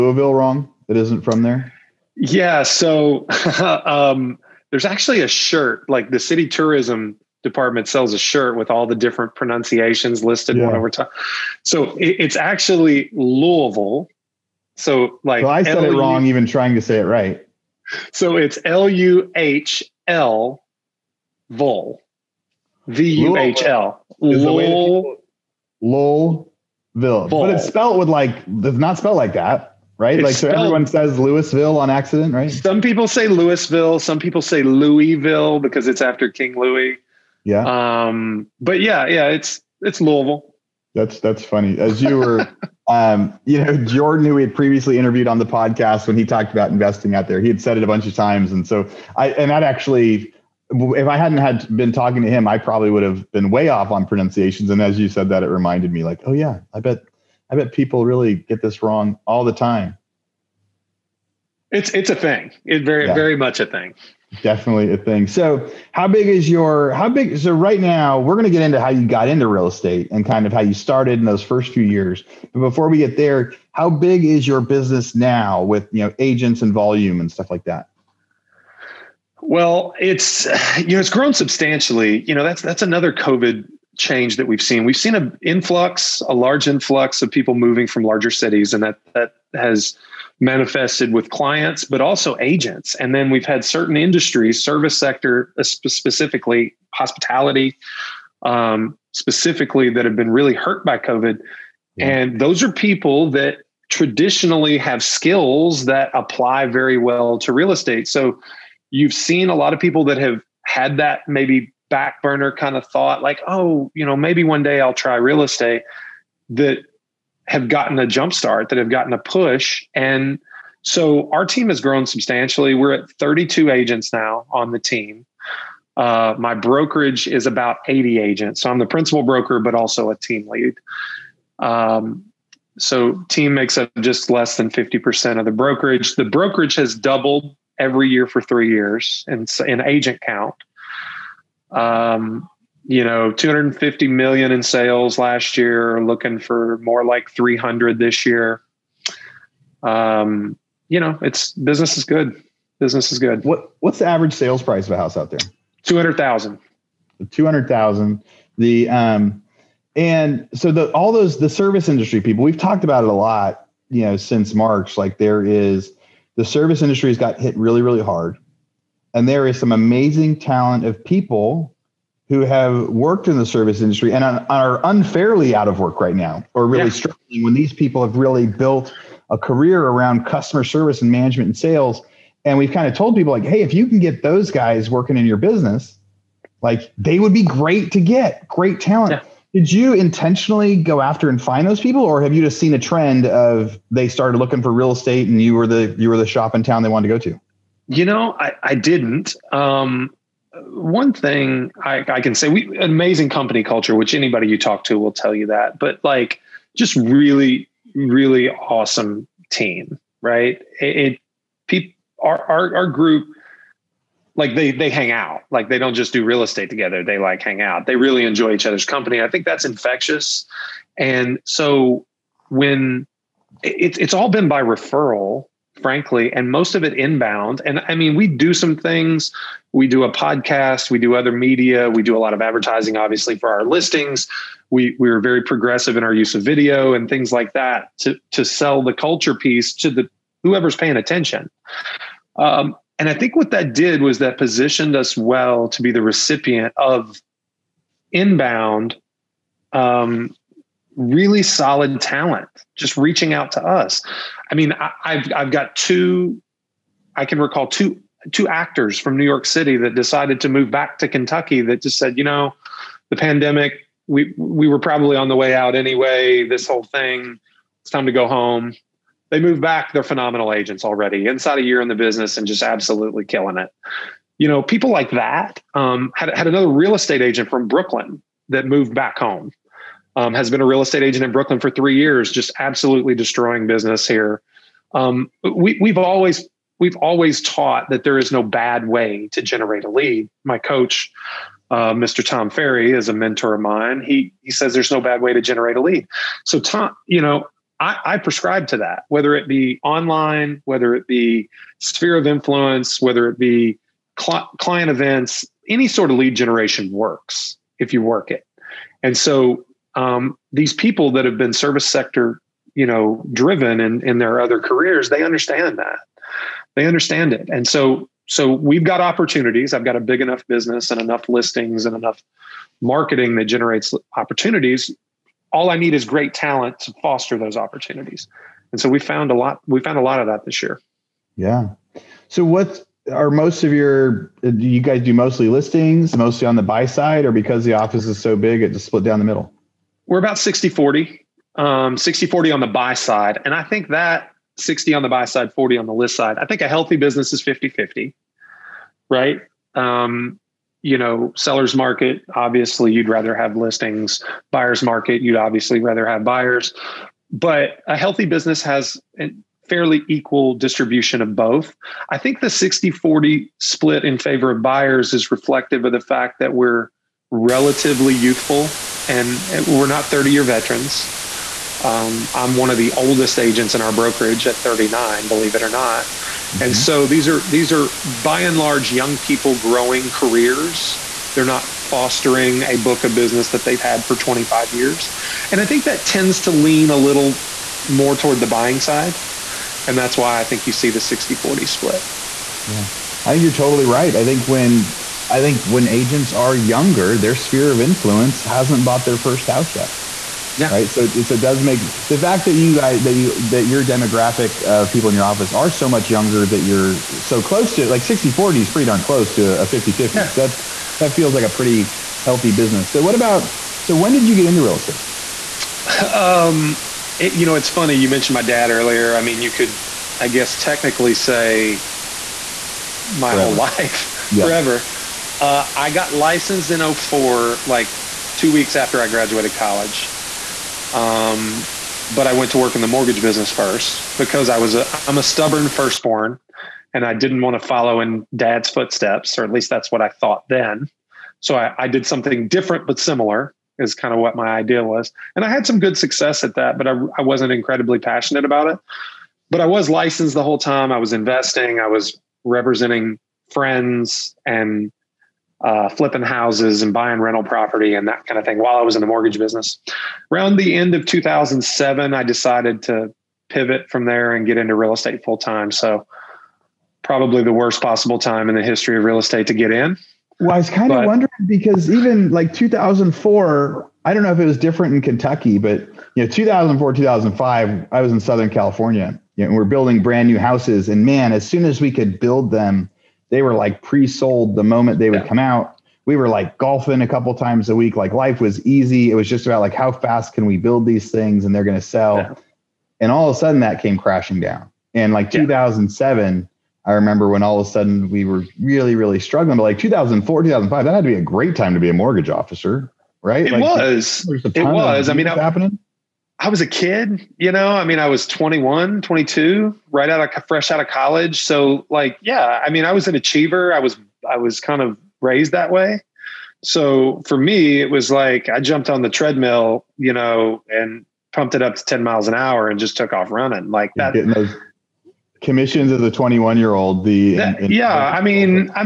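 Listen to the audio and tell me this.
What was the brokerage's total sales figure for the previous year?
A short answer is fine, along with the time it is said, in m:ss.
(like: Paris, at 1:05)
250 million, at 2:23.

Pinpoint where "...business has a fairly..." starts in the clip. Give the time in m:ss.
5:58.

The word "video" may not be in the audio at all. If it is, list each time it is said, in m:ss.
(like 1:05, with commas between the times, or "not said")
3:56.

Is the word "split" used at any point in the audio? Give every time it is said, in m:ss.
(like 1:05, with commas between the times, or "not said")
5:38, 6:03, 6:31.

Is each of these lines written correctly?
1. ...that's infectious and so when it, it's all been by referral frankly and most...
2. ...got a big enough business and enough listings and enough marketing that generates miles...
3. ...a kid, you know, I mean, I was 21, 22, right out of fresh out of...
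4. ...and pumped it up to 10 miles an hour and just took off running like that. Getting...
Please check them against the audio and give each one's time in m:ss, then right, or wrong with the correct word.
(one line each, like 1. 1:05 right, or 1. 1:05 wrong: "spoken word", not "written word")
1. 3:39 right
2. 5:19 wrong: "opportunities", not "miles"
3. 8:26 right
4. 8:40 right.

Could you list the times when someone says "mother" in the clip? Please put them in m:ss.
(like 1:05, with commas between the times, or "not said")
not said.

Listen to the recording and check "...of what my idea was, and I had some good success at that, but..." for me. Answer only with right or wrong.
right.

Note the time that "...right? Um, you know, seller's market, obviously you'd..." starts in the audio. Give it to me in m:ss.
5:49.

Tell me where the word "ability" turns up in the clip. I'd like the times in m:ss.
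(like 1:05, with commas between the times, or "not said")
not said.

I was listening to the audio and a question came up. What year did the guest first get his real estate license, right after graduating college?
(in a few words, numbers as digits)
2004.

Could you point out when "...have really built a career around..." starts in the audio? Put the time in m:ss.
2:58.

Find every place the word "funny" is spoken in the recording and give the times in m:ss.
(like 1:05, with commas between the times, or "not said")
0:41, 6:57.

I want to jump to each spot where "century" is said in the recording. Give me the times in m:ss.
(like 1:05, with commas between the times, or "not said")
not said.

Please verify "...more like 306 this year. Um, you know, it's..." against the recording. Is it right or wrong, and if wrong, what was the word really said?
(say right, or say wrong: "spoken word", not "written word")
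wrong: "300", not "306".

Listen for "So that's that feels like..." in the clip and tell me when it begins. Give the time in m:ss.
6:50.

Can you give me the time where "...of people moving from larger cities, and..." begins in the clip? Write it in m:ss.
1:27.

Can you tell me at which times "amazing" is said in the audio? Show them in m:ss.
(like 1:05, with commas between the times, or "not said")
2:49, 3:22.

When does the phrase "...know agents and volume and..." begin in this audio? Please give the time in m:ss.
1:16.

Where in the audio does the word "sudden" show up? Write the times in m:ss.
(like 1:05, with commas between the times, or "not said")
8:13, 8:17.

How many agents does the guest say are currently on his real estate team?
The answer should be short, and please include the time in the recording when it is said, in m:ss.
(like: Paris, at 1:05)
32, at 2:03.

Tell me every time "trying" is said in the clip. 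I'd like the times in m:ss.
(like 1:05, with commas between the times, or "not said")
0:16.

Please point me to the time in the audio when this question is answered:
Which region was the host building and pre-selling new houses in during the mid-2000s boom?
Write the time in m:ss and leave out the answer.
7:58.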